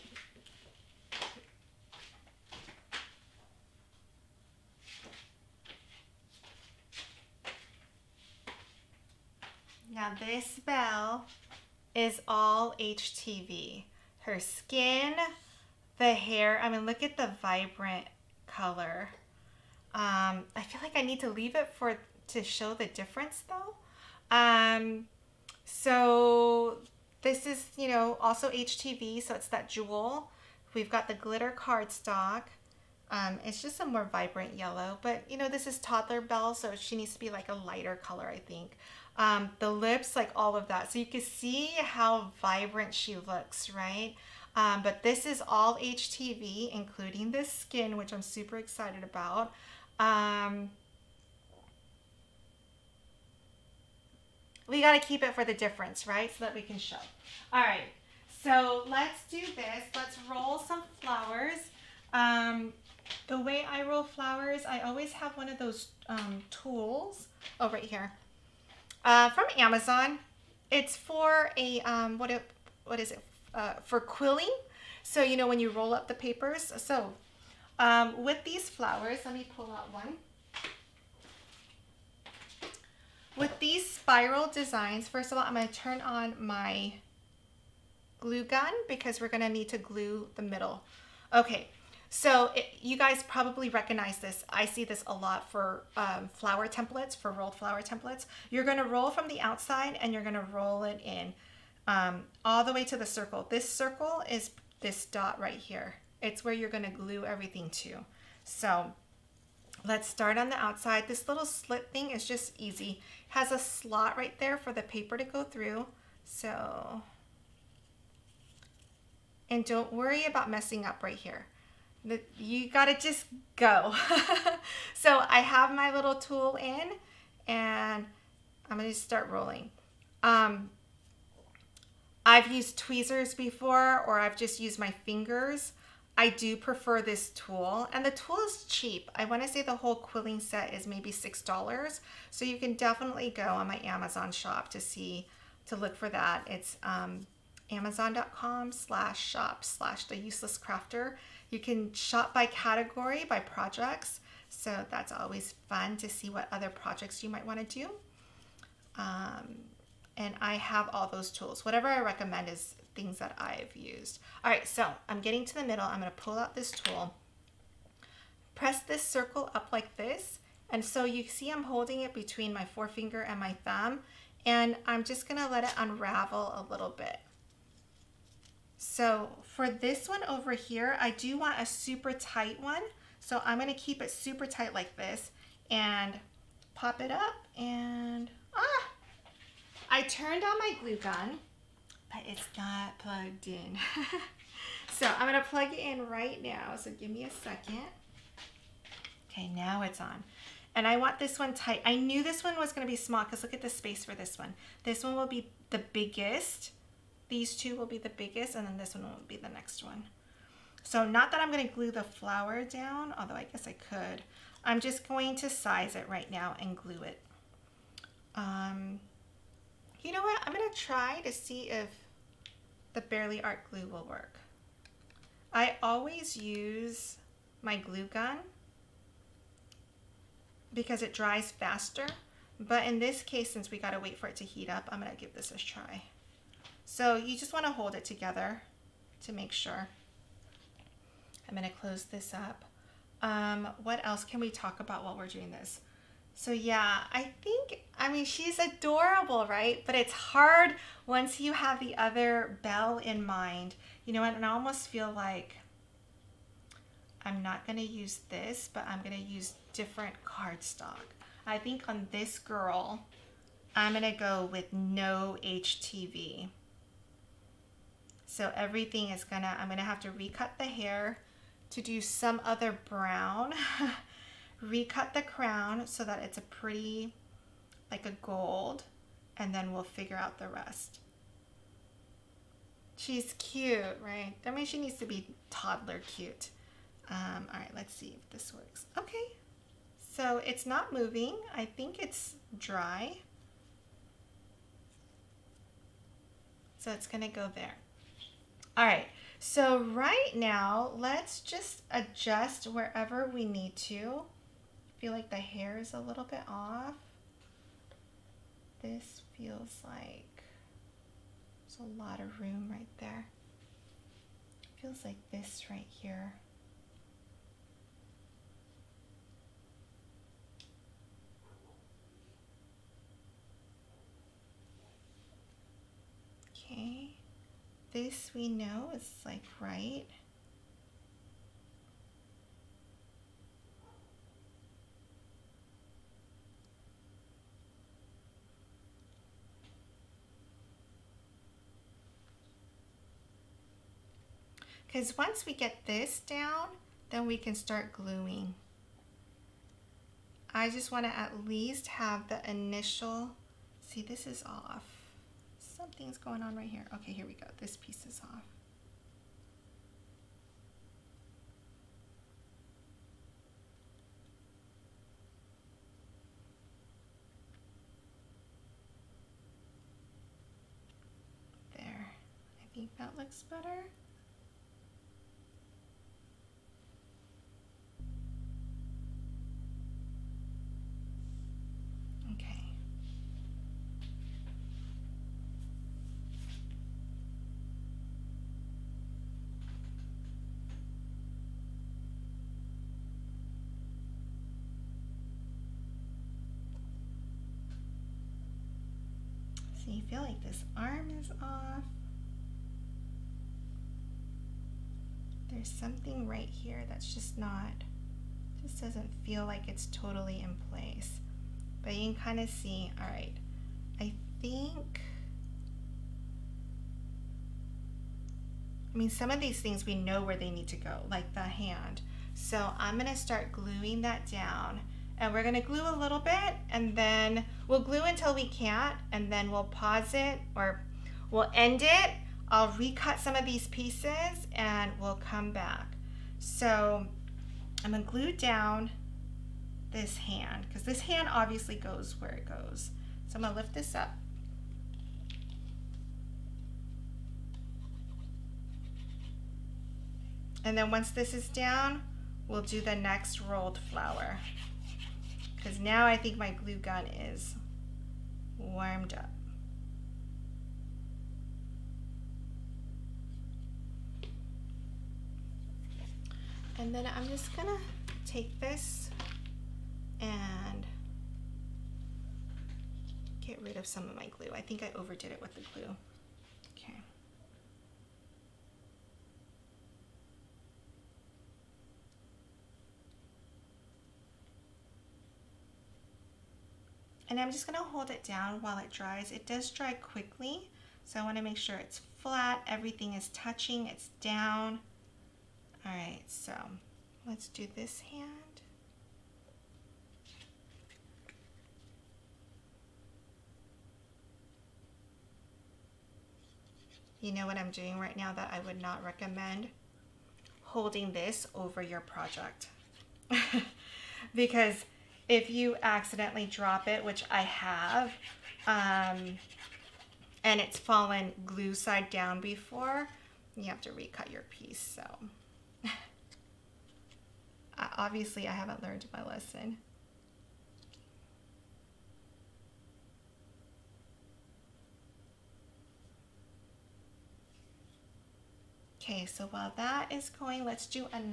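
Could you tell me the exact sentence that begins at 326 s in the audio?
Okay, this we know is like right.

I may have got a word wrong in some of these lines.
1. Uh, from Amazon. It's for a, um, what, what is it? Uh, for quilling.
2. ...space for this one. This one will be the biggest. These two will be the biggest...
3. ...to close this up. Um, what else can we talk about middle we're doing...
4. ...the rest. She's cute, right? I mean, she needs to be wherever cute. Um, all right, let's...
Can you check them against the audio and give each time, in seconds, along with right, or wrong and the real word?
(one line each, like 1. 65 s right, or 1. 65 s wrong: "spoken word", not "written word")
1. 69 s right
2. 203 s right
3. 241 s wrong: "while", not "middle"
4. 280 s wrong: "toddler", not "wherever".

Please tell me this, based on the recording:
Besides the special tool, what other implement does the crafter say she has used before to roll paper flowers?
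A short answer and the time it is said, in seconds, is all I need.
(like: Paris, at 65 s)
tweezers, at 132 s.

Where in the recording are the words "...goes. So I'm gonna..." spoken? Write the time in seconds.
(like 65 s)
442 s.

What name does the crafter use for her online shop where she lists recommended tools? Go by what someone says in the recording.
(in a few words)
The Useless Crafter.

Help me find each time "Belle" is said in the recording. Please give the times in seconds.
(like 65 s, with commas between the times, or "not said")
10 s, 36 s, 252 s.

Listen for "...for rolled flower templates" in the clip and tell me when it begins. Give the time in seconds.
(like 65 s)
97 s.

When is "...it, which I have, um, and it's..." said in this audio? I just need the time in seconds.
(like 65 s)
516 s.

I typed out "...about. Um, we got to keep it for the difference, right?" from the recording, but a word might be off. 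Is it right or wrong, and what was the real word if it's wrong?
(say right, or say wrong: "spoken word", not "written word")
right.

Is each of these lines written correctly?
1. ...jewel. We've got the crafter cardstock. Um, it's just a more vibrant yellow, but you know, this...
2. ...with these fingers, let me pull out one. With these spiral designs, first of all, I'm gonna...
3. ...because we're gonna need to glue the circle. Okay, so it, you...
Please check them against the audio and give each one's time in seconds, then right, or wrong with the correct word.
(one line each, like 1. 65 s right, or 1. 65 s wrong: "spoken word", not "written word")
1. 29 s wrong: "glitter", not "crafter"
2. 78 s wrong: "flowers", not "fingers"
3. 88 s wrong: "middle", not "circle".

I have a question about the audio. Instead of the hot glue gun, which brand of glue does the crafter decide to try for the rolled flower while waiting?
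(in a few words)
Bearly Art.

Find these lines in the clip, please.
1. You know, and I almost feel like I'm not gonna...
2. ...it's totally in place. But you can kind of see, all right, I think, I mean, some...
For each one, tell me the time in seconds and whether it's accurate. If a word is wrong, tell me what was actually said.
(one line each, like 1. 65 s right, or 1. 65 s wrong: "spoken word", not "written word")
1. 254 s right
2. 409 s right.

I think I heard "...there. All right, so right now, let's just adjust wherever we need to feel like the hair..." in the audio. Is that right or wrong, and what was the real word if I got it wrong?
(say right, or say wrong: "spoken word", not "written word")
right.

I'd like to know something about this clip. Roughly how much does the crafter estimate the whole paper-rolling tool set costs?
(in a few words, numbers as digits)
$6.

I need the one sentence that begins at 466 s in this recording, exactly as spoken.
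And then I'm just gonna take this and get rid of some of my glue.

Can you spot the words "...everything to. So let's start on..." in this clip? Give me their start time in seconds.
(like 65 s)
107 s.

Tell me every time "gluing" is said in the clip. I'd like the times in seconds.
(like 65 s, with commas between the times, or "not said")
347 s, 423 s.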